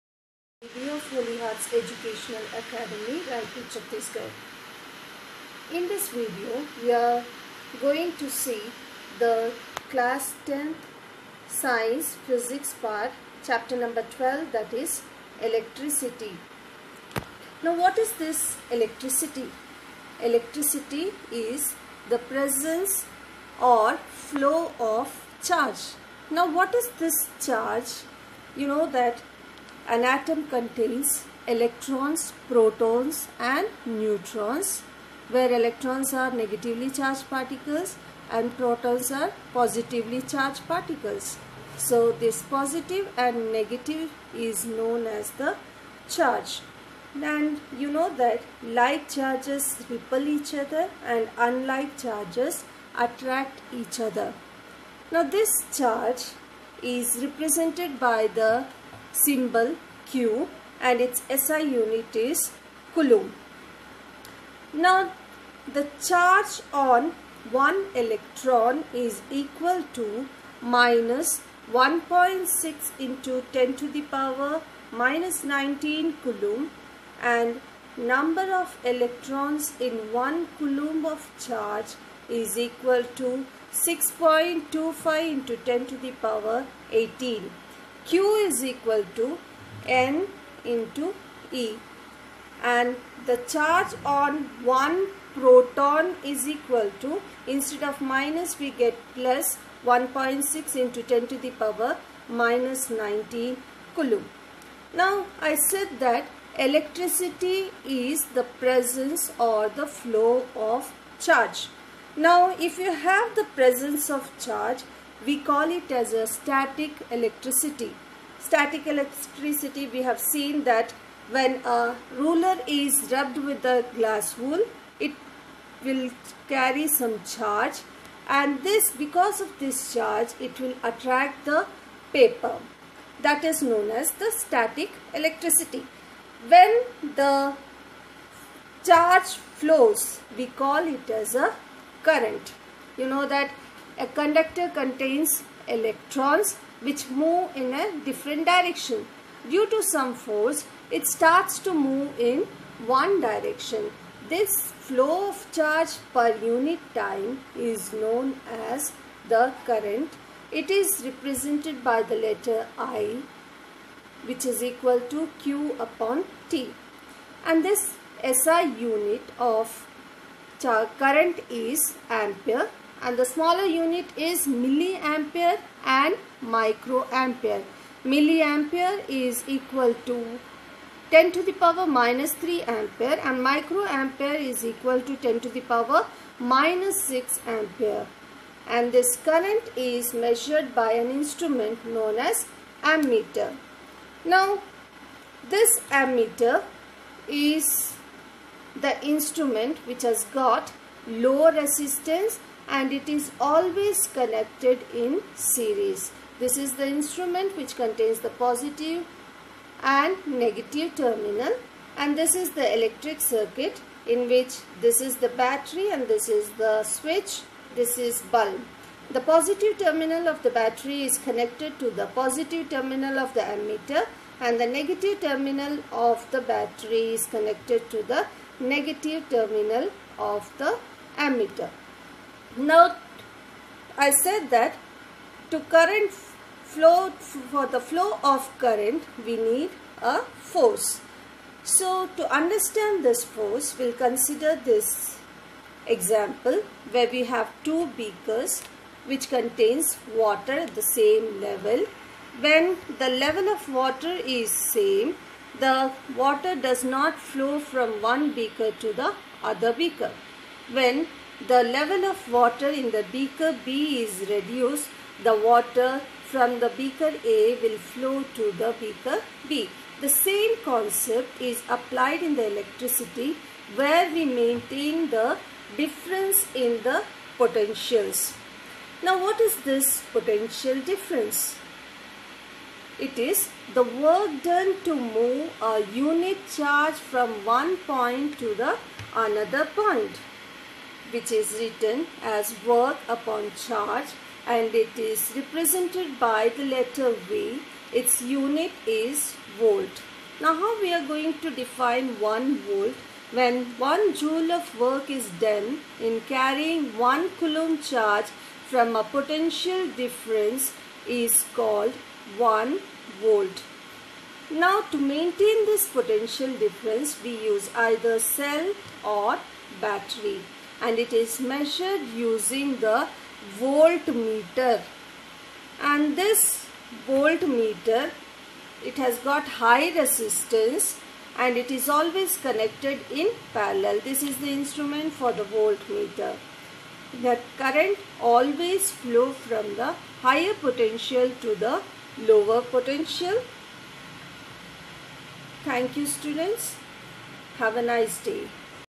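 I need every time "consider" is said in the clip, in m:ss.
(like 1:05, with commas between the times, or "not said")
4:03.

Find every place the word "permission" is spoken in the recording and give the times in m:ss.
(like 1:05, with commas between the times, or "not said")
not said.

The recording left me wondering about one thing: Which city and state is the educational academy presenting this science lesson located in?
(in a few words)
Raipur, Chhattisgarh.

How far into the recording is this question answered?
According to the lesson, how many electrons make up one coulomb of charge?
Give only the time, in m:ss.
1:23.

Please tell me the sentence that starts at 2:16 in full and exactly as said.
When the charge flows we call it as a current.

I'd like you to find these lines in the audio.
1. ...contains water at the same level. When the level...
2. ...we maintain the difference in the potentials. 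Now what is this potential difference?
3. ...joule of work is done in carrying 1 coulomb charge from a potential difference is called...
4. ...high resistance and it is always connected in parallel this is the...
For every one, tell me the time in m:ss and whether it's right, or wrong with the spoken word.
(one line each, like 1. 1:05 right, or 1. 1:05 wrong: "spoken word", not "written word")
1. 4:09 right
2. 4:34 right
3. 5:04 right
4. 5:29 right.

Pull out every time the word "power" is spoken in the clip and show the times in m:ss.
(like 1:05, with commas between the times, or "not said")
1:14, 1:26, 1:41, 3:01, 3:05.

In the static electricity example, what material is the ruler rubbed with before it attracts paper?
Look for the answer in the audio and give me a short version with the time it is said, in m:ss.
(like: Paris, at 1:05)
glass wool, at 2:03.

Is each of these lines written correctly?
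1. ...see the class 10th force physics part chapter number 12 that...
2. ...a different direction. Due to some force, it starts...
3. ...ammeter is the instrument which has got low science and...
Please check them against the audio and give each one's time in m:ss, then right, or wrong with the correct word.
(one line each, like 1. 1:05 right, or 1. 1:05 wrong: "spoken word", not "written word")
1. 0:08 wrong: "science", not "force"
2. 2:27 right
3. 3:15 wrong: "resistance", not "science".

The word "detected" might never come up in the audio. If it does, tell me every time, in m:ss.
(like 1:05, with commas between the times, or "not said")
not said.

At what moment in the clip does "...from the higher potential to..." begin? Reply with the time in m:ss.
5:39.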